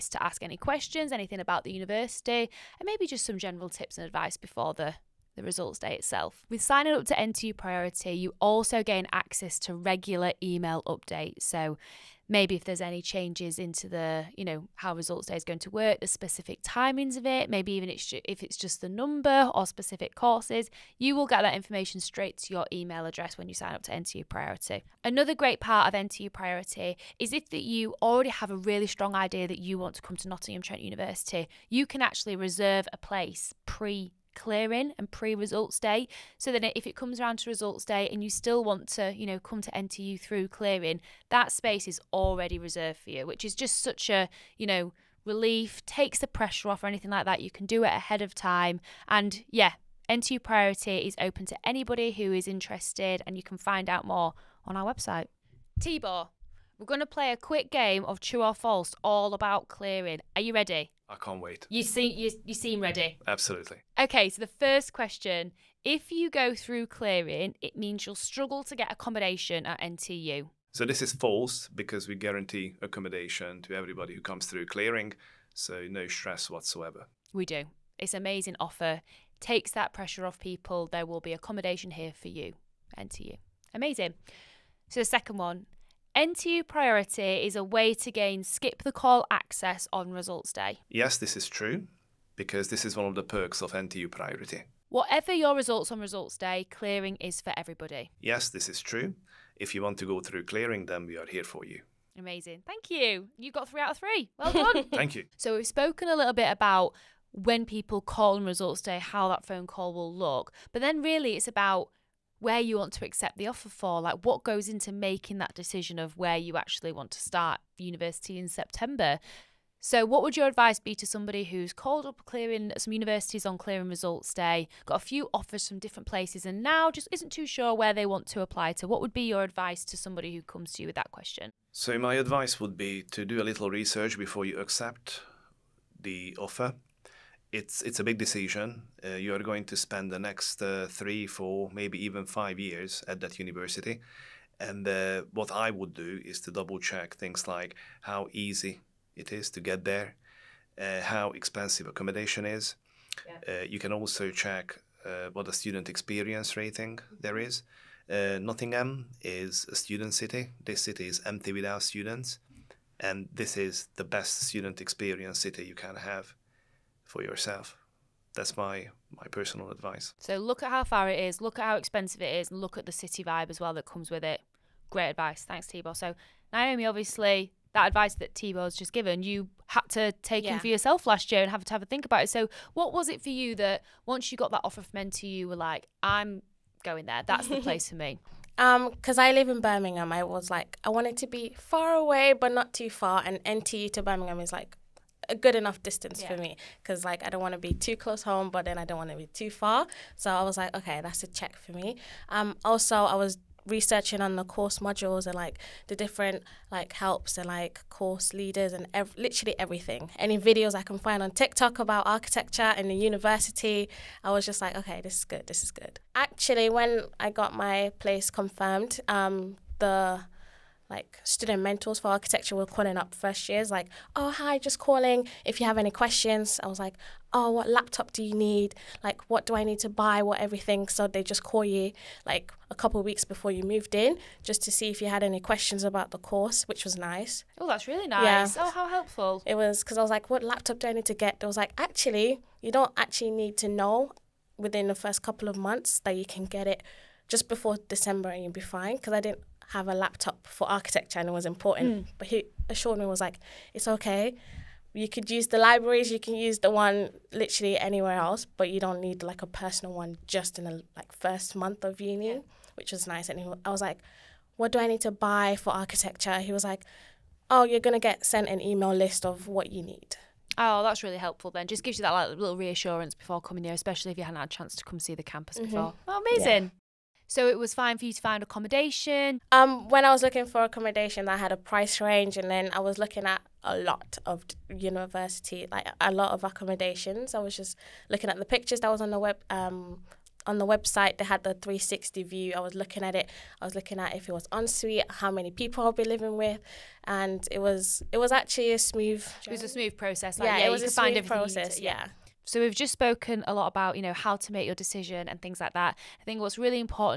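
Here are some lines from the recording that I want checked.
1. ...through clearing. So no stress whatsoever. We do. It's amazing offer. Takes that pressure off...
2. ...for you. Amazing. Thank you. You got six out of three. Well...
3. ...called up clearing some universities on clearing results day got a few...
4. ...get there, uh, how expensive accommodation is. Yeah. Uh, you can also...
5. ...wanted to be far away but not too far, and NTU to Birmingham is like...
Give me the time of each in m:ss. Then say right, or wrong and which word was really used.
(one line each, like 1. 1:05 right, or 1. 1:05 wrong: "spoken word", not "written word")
1. 1:14 right
2. 1:41 wrong: "three", not "six"
3. 2:01 right
4. 2:29 right
5. 3:10 right.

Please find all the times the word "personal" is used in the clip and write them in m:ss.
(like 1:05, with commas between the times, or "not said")
2:49, 4:19.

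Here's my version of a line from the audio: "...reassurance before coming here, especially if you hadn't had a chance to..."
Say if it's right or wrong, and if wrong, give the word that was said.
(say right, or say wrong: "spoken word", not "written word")
right.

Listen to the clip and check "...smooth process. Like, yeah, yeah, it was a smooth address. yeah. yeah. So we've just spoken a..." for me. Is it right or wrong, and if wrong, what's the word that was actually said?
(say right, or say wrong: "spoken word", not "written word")
wrong: "process", not "address".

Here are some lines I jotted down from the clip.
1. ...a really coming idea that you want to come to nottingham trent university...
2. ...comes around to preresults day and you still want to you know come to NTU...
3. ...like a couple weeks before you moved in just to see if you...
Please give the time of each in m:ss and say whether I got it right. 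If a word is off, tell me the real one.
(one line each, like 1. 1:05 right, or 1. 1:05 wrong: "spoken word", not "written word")
1. 0:28 wrong: "strong", not "coming"
2. 0:36 wrong: "results", not "preresults"
3. 3:52 right.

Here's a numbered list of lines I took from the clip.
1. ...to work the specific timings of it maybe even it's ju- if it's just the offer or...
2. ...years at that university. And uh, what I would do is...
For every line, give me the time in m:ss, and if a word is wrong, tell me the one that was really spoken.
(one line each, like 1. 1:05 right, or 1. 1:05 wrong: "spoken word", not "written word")
1. 0:15 wrong: "number", not "offer"
2. 2:22 right.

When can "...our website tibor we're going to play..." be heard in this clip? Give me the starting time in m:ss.
0:54.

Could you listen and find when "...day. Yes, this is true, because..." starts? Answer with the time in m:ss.
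1:30.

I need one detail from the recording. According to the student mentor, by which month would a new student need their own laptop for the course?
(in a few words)
December.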